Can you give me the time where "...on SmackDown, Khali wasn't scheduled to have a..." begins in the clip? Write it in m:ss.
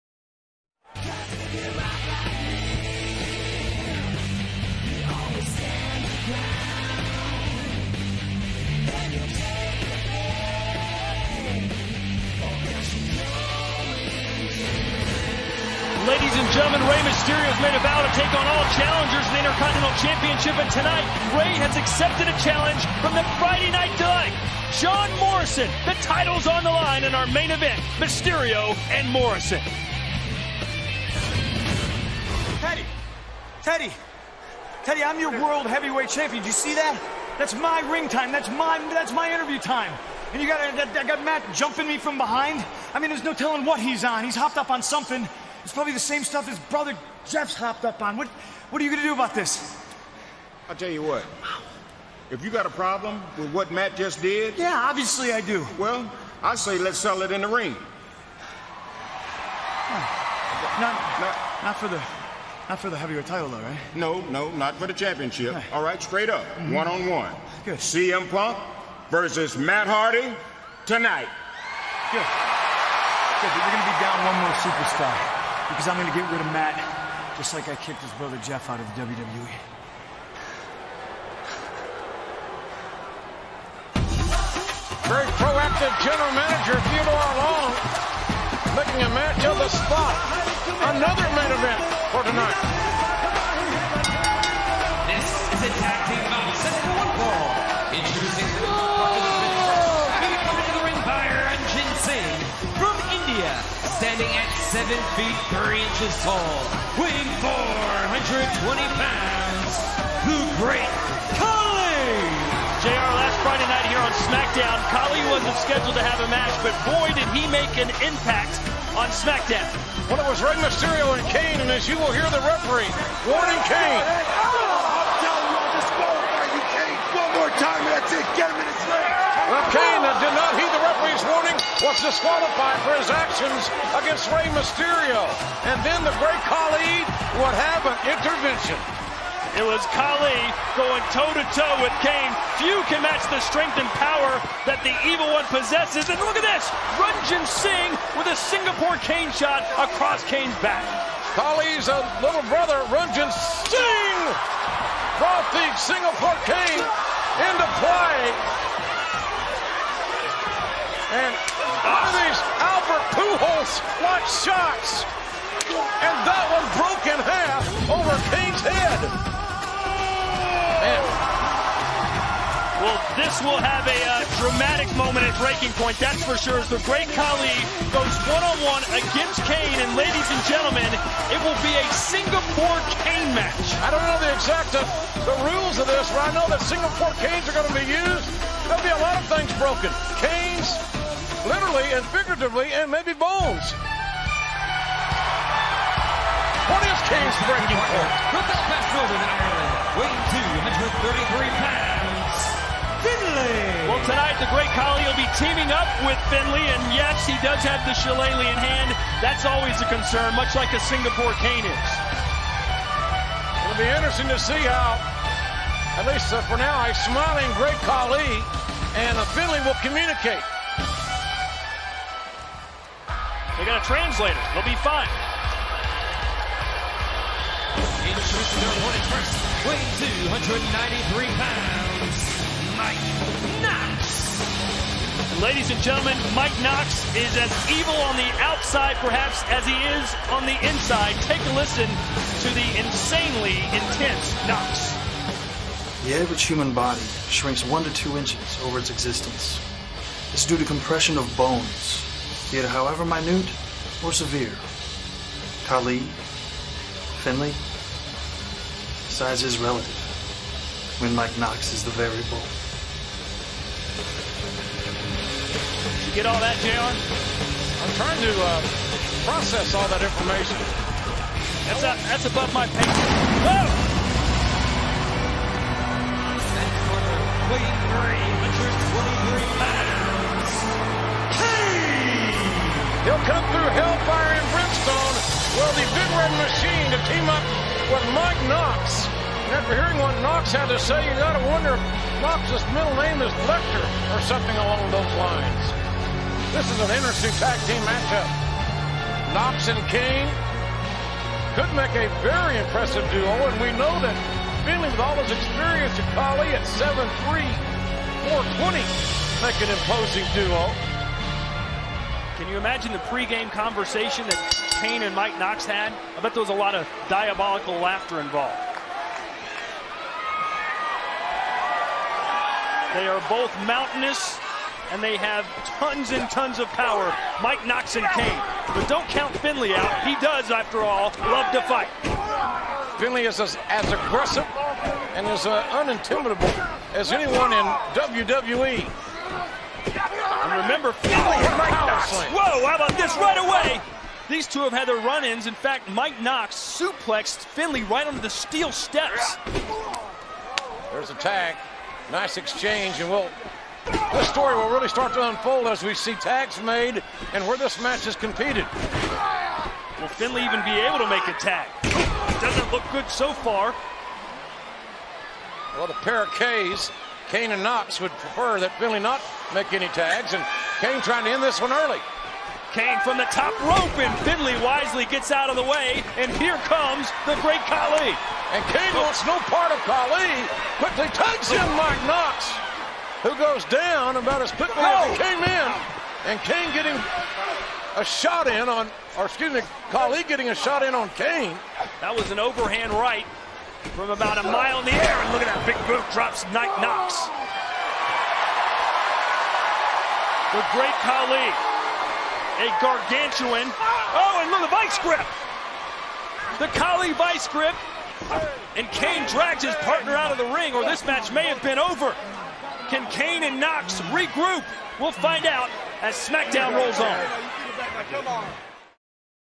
1:54.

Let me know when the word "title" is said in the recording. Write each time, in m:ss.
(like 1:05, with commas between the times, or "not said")
0:25, 1:03.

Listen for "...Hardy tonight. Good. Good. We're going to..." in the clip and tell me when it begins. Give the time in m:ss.
1:09.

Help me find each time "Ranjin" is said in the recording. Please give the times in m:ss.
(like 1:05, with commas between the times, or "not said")
2:27, 2:32.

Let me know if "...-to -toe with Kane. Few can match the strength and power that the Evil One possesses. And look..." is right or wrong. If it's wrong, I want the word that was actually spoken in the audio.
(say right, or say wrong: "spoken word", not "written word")
right.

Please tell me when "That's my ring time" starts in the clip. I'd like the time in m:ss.
0:37.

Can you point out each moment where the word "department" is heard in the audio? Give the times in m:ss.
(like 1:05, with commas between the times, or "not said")
not said.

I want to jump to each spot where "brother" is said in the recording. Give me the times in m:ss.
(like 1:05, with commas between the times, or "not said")
0:46, 1:18, 2:32.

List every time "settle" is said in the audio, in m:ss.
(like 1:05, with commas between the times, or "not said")
0:56.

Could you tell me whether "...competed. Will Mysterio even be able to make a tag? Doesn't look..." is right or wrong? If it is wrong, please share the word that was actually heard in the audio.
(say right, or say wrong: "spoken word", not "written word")
wrong: "Finlay", not "Mysterio".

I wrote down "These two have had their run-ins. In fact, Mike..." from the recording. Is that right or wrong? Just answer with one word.
right.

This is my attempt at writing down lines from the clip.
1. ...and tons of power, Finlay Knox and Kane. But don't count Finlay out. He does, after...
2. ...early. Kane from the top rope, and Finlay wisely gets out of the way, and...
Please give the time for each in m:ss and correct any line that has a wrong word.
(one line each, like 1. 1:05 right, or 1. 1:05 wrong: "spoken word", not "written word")
1. 5:26 wrong: "Mike", not "Finlay"
2. 6:11 right.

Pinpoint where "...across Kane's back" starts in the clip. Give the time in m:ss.
2:29.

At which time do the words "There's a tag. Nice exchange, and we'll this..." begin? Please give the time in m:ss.
5:50.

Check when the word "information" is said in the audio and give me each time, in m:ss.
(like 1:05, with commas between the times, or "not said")
4:30.